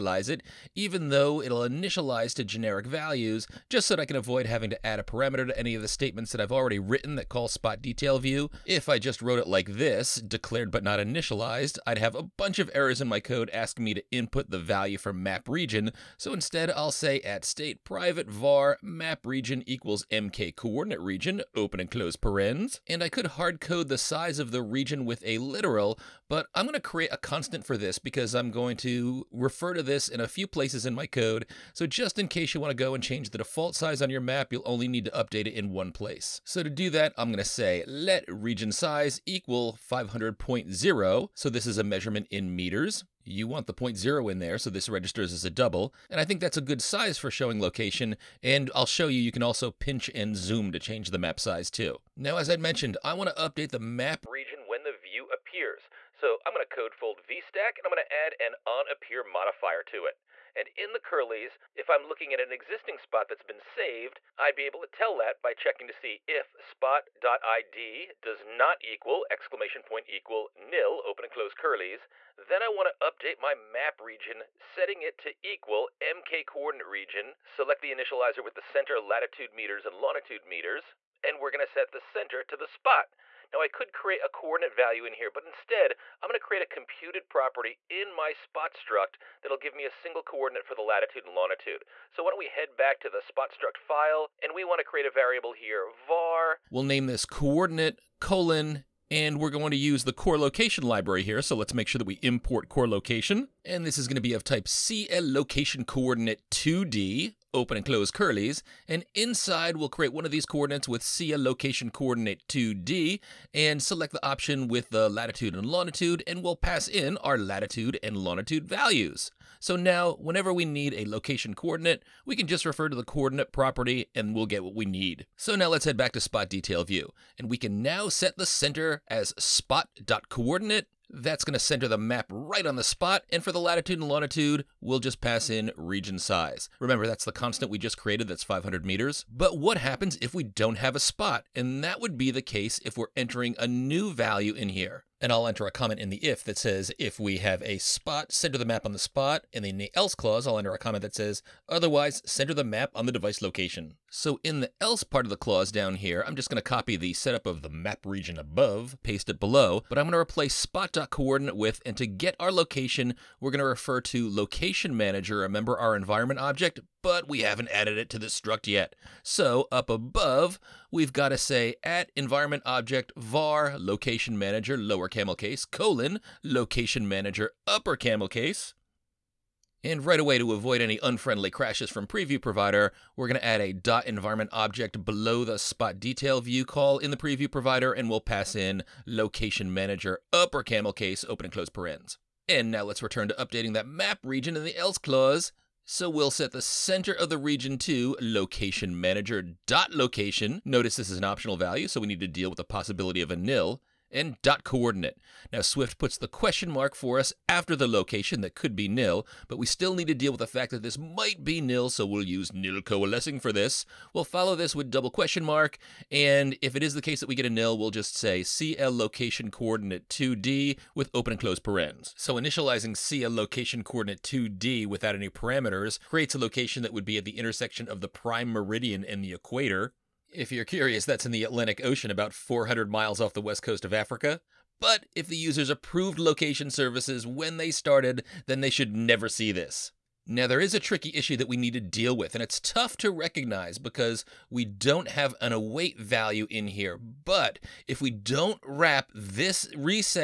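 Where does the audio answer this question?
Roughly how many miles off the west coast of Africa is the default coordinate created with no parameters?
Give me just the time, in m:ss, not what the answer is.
3:52.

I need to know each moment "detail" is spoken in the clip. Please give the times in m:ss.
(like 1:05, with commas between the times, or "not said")
0:07, 2:06, 3:05.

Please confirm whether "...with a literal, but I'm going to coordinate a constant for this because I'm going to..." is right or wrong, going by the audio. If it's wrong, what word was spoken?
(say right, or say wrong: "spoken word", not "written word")
wrong: "create", not "coordinate".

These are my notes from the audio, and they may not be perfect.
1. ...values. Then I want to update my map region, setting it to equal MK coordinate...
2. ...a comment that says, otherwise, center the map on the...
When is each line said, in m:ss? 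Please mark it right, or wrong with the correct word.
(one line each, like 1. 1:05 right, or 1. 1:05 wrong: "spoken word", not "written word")
1. 1:11 wrong: "curlies", not "values"
2. 2:30 right.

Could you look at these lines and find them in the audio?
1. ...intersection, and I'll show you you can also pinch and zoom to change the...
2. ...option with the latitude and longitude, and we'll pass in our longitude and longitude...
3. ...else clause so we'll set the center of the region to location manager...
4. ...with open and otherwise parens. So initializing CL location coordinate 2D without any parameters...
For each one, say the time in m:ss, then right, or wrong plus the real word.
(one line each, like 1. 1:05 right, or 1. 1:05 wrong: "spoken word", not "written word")
1. 0:47 wrong: "location", not "intersection"
2. 1:54 wrong: "latitude", not "longitude"
3. 3:14 right
4. 3:40 wrong: "close", not "otherwise".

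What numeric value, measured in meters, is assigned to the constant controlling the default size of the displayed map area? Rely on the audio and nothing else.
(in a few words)
500.0.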